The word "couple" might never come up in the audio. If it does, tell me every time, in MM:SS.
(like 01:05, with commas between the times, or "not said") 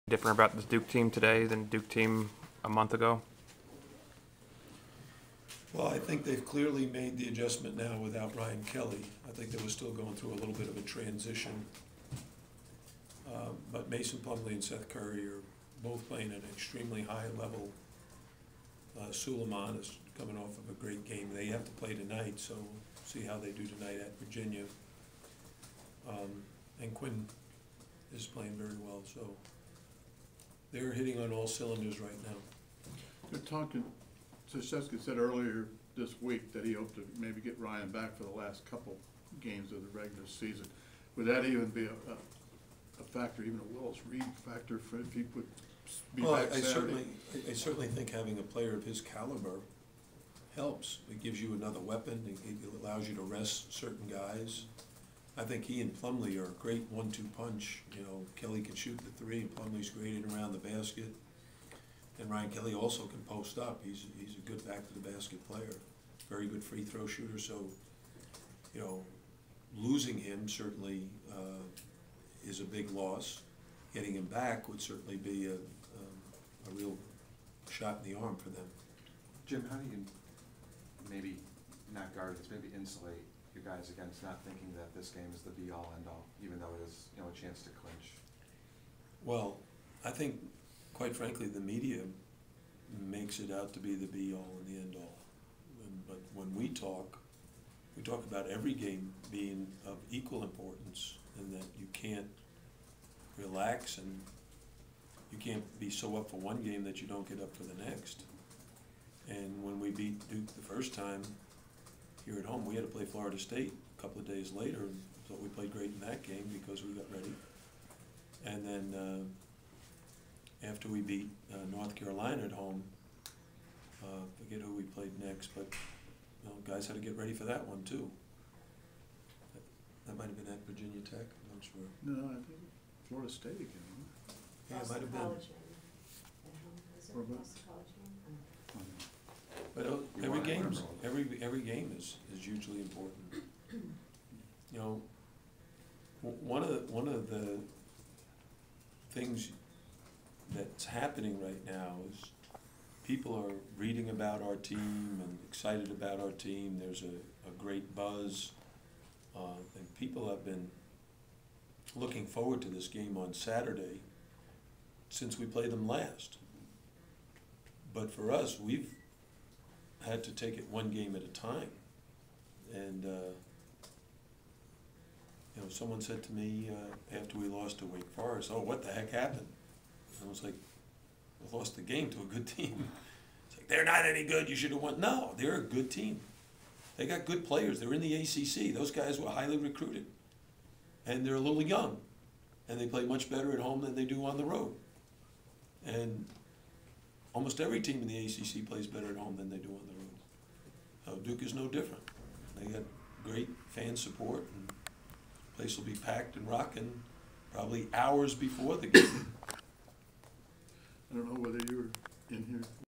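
00:38, 01:54.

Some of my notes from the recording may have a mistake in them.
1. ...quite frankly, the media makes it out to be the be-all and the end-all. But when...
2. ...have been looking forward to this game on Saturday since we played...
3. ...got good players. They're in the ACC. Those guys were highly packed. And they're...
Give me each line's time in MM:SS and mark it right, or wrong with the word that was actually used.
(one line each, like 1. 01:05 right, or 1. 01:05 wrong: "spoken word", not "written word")
1. 01:30 right
2. 02:40 right
3. 03:07 wrong: "recruited", not "packed".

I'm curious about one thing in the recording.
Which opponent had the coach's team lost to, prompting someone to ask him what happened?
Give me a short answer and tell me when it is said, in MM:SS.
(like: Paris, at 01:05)
Wake Forest, at 02:57.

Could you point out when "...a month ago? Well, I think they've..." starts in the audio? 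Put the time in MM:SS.
00:02.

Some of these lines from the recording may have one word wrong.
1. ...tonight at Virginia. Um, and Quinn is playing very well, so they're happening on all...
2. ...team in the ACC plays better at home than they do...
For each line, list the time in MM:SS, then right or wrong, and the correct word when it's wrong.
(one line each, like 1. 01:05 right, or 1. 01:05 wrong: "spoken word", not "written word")
1. 00:23 wrong: "hitting", not "happening"
2. 03:17 right.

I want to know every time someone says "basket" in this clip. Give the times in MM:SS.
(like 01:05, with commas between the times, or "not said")
01:00, 01:05.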